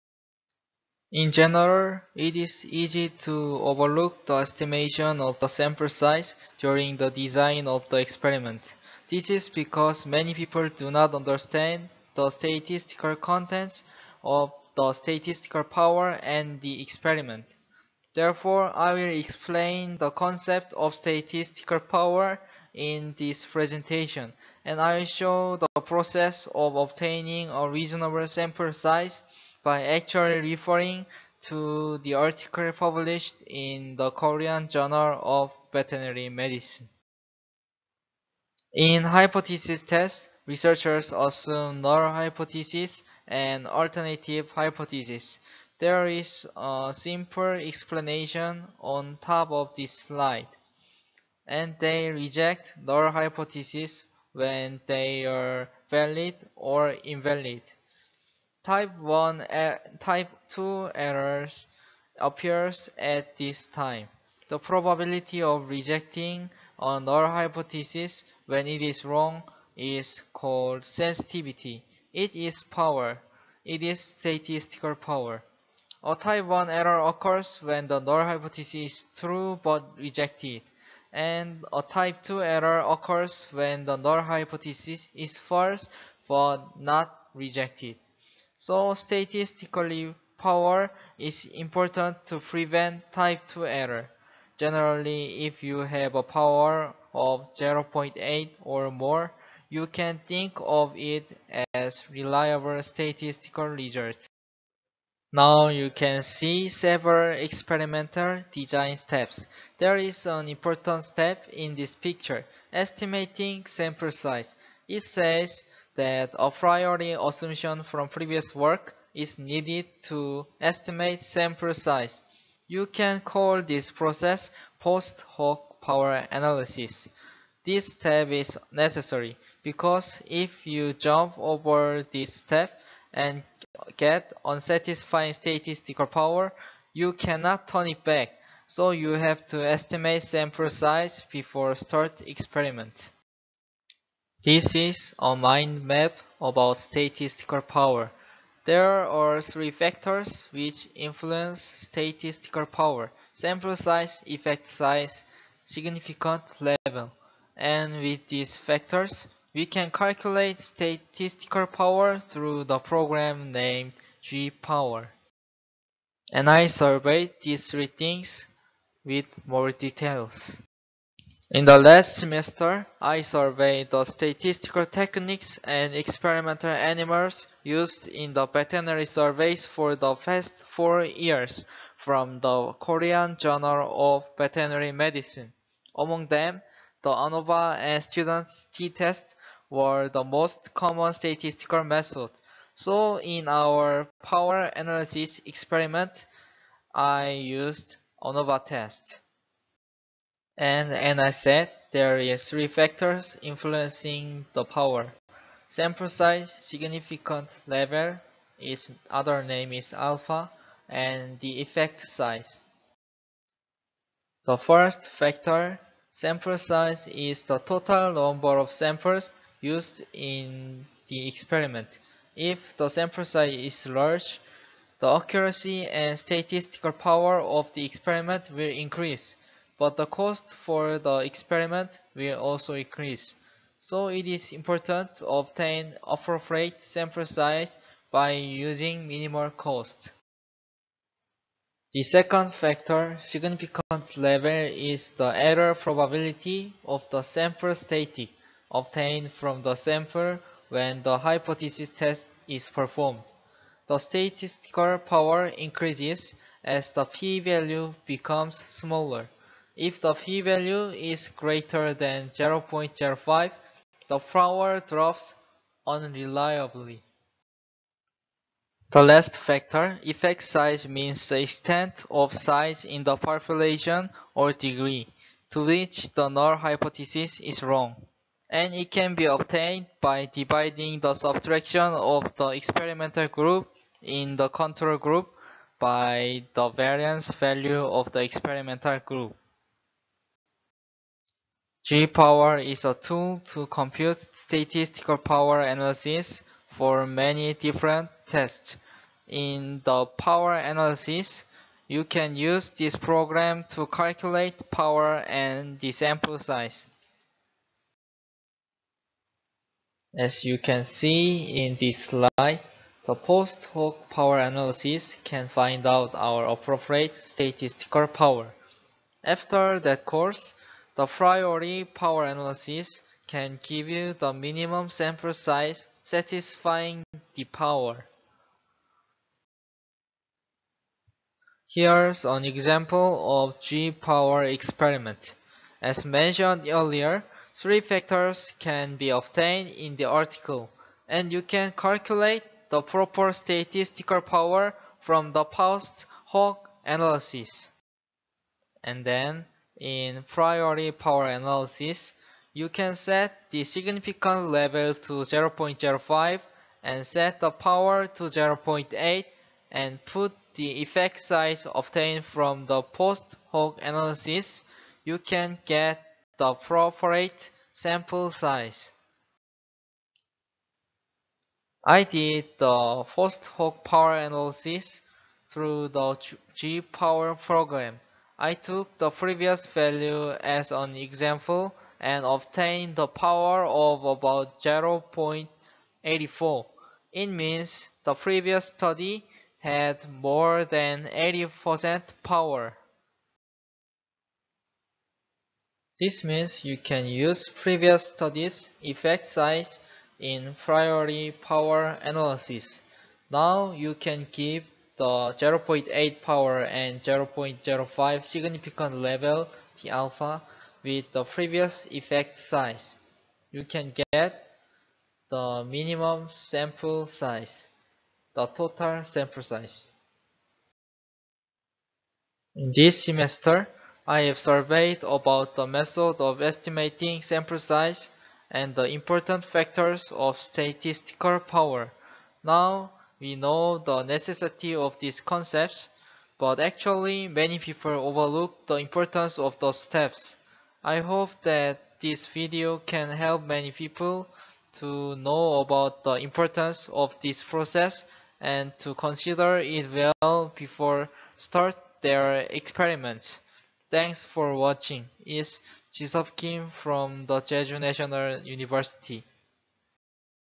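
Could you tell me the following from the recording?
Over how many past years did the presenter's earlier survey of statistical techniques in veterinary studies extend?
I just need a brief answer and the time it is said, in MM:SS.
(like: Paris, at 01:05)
4, at 03:00.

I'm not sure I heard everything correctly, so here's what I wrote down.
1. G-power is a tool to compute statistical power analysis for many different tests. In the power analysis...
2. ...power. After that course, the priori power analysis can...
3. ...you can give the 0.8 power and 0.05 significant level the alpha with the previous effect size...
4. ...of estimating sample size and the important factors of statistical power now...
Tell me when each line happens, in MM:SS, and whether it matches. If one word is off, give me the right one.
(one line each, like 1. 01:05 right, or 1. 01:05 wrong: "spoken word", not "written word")
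1. 04:51 right
2. 05:18 right
3. 06:43 right
4. 07:06 right.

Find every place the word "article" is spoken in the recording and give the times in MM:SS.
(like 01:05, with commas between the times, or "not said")
00:32, 05:40.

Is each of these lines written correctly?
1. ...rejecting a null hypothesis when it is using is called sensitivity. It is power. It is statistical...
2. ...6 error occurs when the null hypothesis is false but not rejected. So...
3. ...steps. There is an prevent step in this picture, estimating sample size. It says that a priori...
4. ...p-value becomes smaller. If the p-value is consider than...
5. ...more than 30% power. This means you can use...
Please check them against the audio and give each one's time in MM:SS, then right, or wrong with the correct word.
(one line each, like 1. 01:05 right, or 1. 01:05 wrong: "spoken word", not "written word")
1. 01:05 wrong: "wrong", not "using"
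2. 01:22 wrong: "2", not "6"
3. 01:48 wrong: "important", not "prevent"
4. 04:17 wrong: "greater", not "consider"
5. 06:30 wrong: "80", not "30".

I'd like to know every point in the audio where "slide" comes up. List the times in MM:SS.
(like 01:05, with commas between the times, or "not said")
00:49, 05:12.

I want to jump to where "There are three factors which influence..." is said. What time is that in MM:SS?
02:28.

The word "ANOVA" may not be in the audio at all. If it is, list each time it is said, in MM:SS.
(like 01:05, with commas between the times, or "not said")
03:07, 03:18.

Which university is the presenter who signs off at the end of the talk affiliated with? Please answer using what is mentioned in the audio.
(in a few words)
Jeju National University.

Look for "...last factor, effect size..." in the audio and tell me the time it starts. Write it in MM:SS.
04:29.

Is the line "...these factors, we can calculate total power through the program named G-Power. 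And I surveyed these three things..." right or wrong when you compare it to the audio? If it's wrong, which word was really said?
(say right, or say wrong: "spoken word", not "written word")
wrong: "statistical", not "total".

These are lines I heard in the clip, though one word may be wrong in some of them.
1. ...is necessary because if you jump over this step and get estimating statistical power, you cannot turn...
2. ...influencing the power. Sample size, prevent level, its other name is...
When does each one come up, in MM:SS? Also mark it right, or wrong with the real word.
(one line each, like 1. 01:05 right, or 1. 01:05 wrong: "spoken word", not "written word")
1. 02:08 wrong: "unsatisfying", not "estimating"
2. 03:23 wrong: "significant", not "prevent".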